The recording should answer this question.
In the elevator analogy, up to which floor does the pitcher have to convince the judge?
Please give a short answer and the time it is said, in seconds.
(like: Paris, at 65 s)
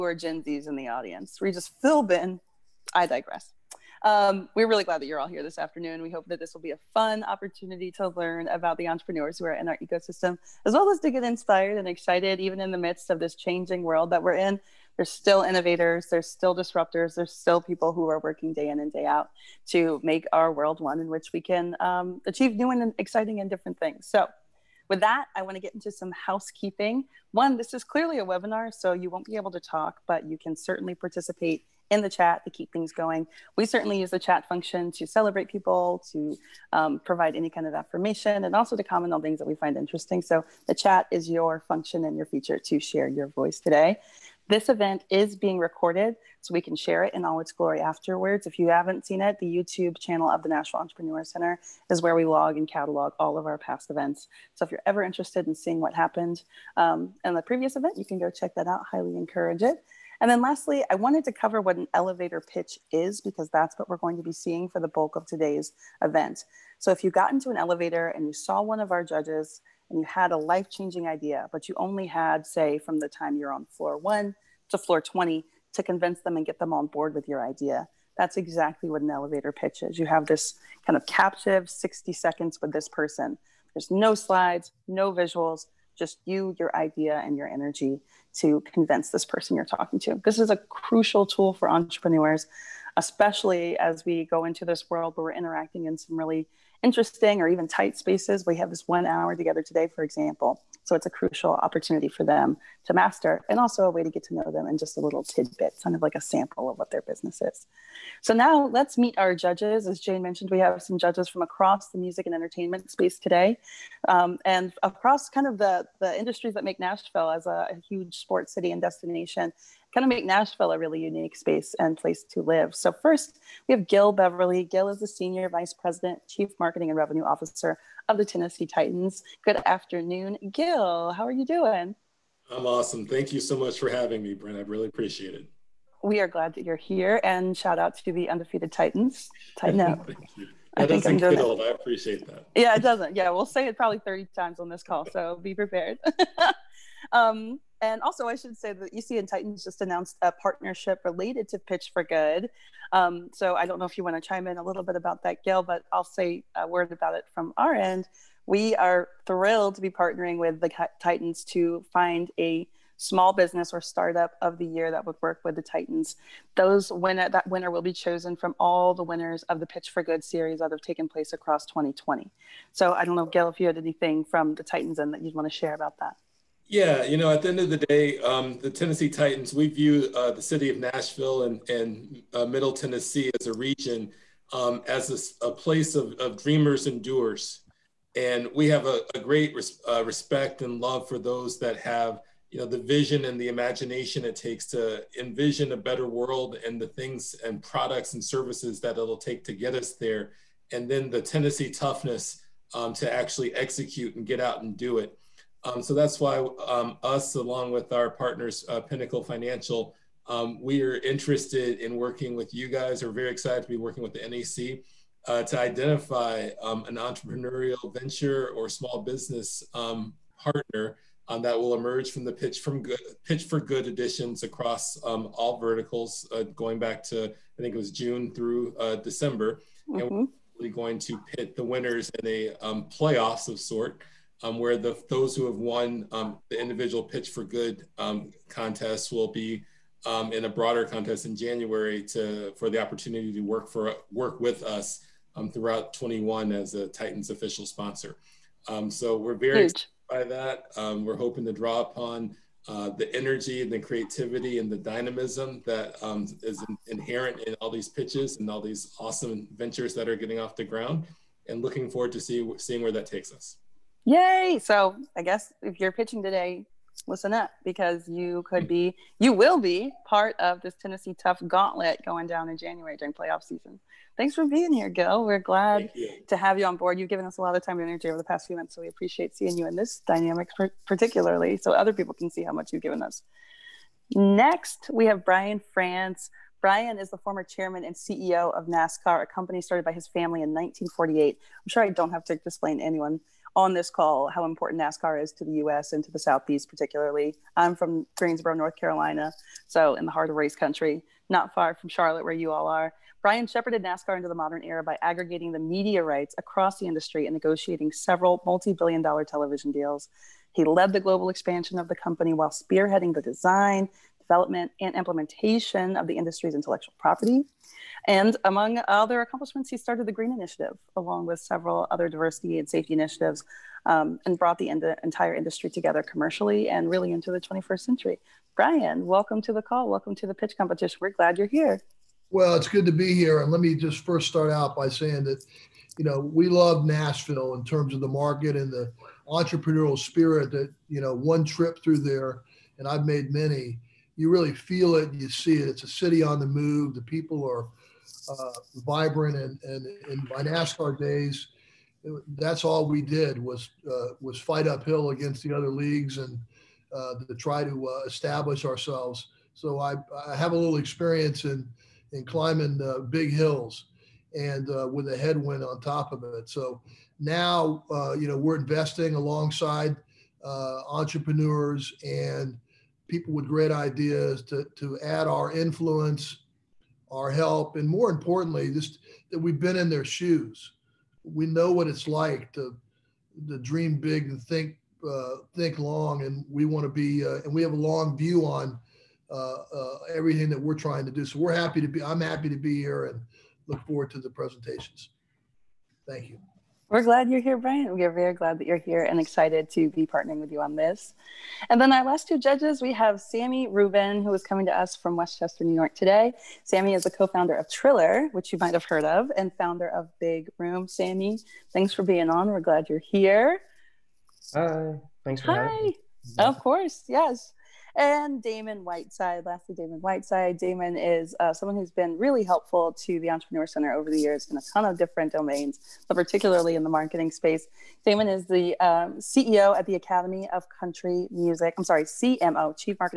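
20, at 74 s.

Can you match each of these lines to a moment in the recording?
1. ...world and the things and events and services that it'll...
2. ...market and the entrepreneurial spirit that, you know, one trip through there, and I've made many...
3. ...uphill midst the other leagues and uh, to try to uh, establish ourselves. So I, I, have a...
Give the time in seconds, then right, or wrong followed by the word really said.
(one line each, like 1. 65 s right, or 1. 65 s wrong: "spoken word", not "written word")
1. 196 s wrong: "products", not "events"
2. 338 s right
3. 354 s wrong: "against", not "midst".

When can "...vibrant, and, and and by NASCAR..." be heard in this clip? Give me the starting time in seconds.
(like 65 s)
348 s.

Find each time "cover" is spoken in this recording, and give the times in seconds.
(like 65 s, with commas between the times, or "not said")
61 s.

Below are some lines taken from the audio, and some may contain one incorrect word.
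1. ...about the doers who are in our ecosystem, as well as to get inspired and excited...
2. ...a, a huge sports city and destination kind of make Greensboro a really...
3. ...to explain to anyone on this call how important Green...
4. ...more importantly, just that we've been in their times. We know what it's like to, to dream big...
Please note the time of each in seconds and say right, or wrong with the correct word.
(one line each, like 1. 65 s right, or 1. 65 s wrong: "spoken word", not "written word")
1. 8 s wrong: "entrepreneurs", not "doers"
2. 117 s wrong: "Nashville", not "Greensboro"
3. 292 s wrong: "NASCAR", not "Green"
4. 377 s wrong: "shoes", not "times".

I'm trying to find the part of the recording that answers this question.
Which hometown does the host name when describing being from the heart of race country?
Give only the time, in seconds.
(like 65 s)
298 s.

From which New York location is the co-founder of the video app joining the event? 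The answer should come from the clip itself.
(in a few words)
Westchester.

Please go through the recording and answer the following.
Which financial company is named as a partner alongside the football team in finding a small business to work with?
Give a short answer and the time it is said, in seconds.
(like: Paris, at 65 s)
Pinnacle Financial, at 208 s.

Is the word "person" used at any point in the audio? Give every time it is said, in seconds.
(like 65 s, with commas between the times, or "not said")
82 s, 89 s.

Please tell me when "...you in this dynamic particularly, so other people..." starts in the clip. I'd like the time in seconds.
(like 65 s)
279 s.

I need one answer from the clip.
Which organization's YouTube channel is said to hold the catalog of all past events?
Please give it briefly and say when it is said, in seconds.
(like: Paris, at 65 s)
Nashville Entrepreneur Center, at 50 s.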